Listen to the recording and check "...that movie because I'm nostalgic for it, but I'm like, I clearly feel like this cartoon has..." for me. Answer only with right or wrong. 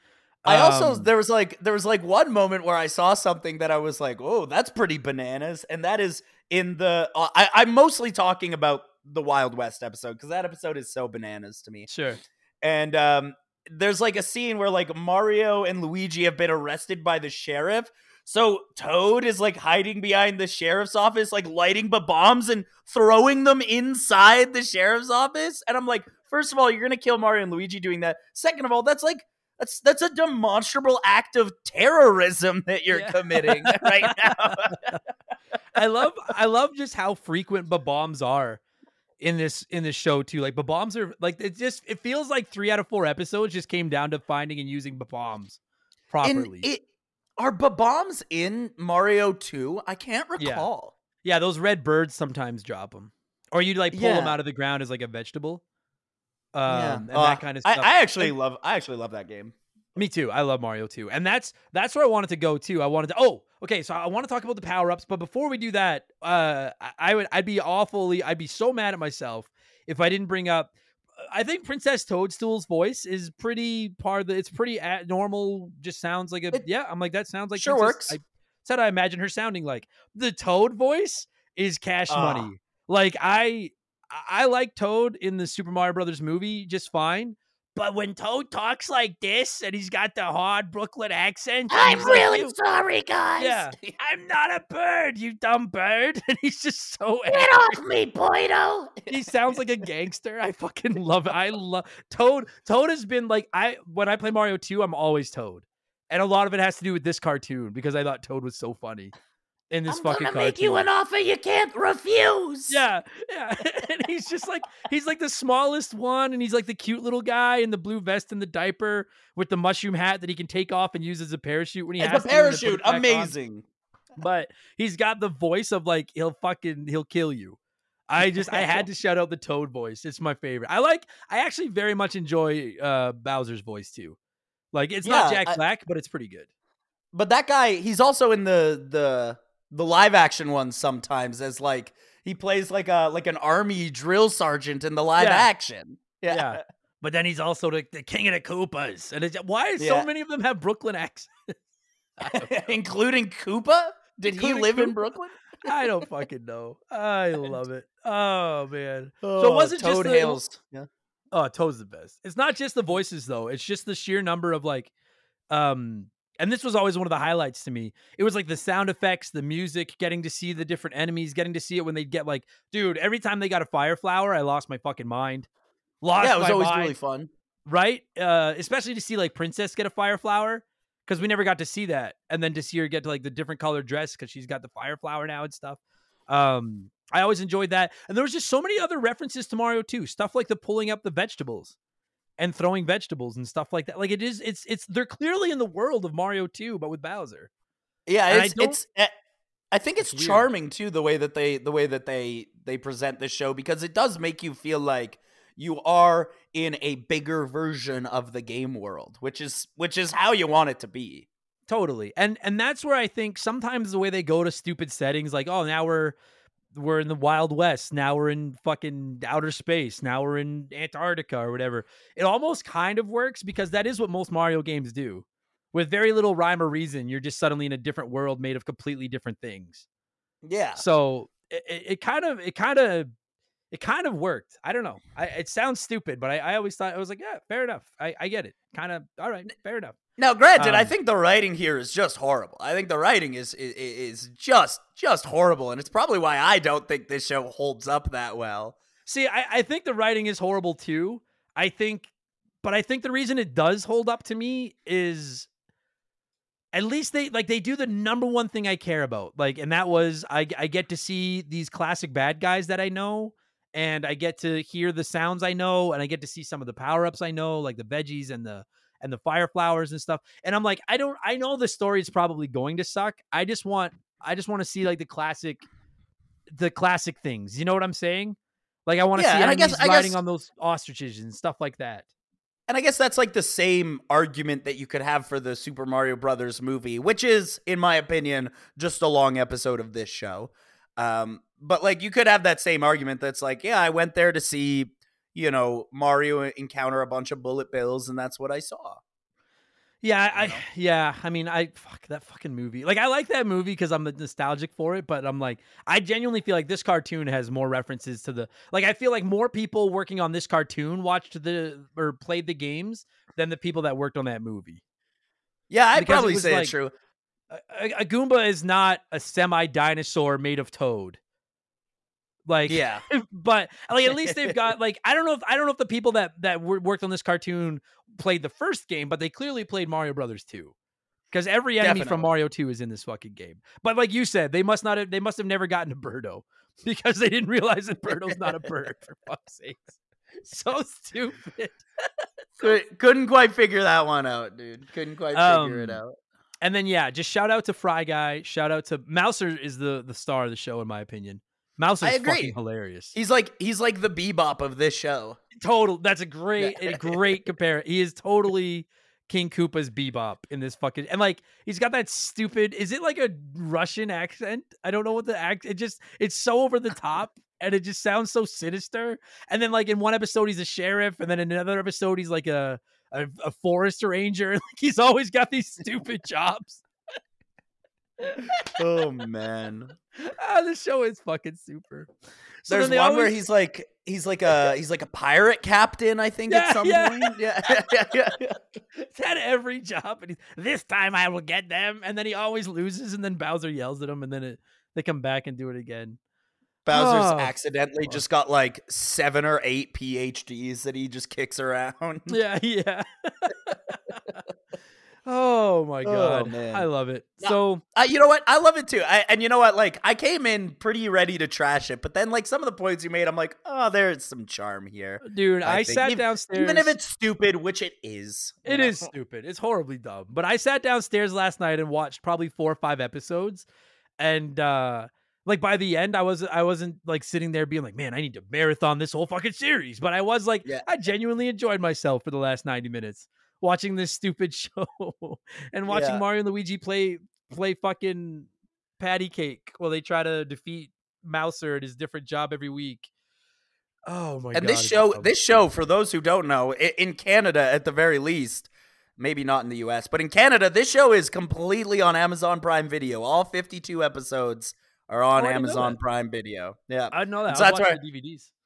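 wrong.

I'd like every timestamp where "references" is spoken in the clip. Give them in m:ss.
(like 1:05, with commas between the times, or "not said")
3:08, 5:07.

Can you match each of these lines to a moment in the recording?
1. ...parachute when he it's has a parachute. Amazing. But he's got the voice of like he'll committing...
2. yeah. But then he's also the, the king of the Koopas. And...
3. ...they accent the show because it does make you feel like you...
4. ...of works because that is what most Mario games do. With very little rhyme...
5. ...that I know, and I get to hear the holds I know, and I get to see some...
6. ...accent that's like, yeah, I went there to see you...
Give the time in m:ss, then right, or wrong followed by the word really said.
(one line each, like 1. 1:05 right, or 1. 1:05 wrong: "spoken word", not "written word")
1. 2:01 wrong: "fucking", not "committing"
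2. 2:26 right
3. 3:22 wrong: "present", not "accent"
4. 3:42 right
5. 4:22 wrong: "sounds", not "holds"
6. 4:52 wrong: "argument", not "accent".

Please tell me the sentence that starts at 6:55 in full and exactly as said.
I, I sat even, downstairs, even if it's stupid, which it is.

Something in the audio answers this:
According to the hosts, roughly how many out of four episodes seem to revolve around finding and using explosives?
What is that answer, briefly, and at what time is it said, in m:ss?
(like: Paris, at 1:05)
3, at 0:42.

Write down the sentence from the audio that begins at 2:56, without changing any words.
Lost yeah, it was always mind.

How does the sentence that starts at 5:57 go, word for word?
He is totally King Koopa's bebop in this fucking and like he's got that stupid.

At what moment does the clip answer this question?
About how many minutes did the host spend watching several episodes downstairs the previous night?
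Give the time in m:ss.
7:12.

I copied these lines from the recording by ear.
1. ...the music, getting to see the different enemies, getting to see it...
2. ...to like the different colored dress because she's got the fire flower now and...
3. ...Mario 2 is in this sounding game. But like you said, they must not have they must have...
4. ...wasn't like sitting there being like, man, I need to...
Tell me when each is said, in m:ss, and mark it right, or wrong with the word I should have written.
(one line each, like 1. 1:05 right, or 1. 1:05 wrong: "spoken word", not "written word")
1. 2:49 right
2. 3:03 right
3. 5:32 wrong: "fucking", not "sounding"
4. 7:06 right.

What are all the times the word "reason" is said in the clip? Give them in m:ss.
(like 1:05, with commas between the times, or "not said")
3:46, 4:13.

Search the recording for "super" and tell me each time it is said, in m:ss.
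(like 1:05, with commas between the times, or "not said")
1:25, 4:45, 6:21.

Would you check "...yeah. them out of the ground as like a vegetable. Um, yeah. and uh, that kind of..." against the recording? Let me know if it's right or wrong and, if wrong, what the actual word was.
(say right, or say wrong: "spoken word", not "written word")
right.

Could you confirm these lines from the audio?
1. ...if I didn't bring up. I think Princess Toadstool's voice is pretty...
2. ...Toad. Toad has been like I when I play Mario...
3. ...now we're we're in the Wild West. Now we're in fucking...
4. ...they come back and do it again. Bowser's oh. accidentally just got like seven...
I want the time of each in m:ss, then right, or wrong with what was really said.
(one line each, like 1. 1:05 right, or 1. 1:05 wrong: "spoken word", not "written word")
1. 1:09 right
2. 1:42 right
3. 3:35 right
4. 6:34 right.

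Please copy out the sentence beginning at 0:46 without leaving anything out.
And it, are bombs in Mario Two?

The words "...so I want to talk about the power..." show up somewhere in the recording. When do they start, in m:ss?
1:03.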